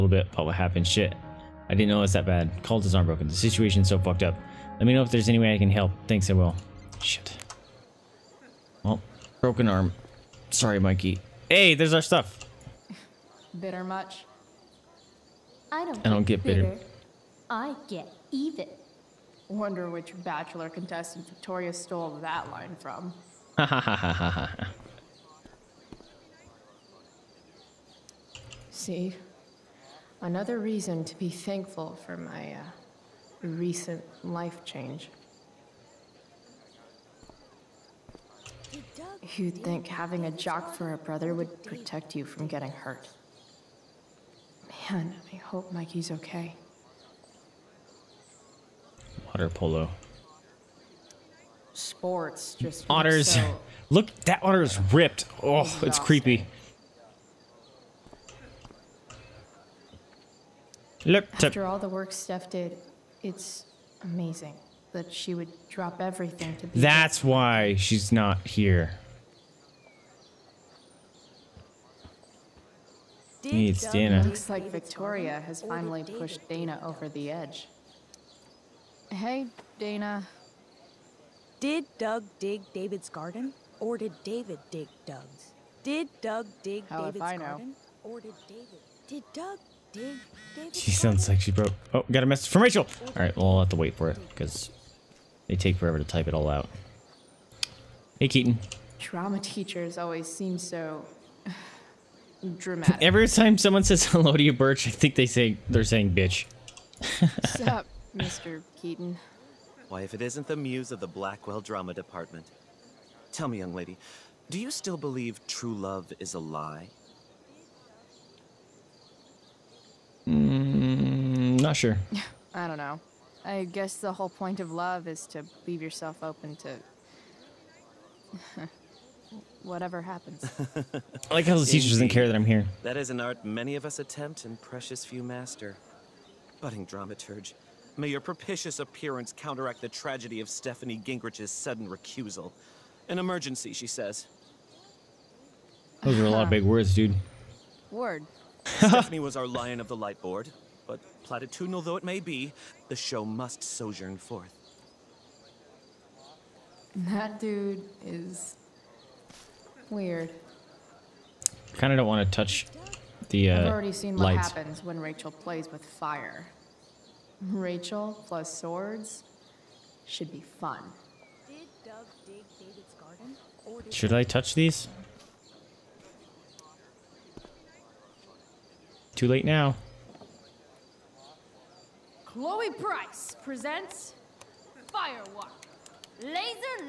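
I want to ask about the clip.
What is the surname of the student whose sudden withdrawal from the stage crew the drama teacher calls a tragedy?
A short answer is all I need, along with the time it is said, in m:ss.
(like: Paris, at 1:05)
Gingrich, at 2:21.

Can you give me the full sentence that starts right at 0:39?
You'd think having a jock for a brother would protect you from getting hurt.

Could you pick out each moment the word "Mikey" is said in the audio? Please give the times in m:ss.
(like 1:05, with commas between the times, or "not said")
0:10, 0:45.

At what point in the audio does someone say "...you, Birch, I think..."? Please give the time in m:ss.
1:44.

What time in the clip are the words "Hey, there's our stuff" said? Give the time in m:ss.
0:11.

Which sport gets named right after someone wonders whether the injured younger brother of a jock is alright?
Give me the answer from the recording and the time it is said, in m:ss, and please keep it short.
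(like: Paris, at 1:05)
Water polo, at 0:49.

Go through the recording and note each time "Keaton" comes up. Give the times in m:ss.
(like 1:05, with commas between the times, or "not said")
1:38, 1:48.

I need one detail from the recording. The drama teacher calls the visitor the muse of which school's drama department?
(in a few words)
Blackwell.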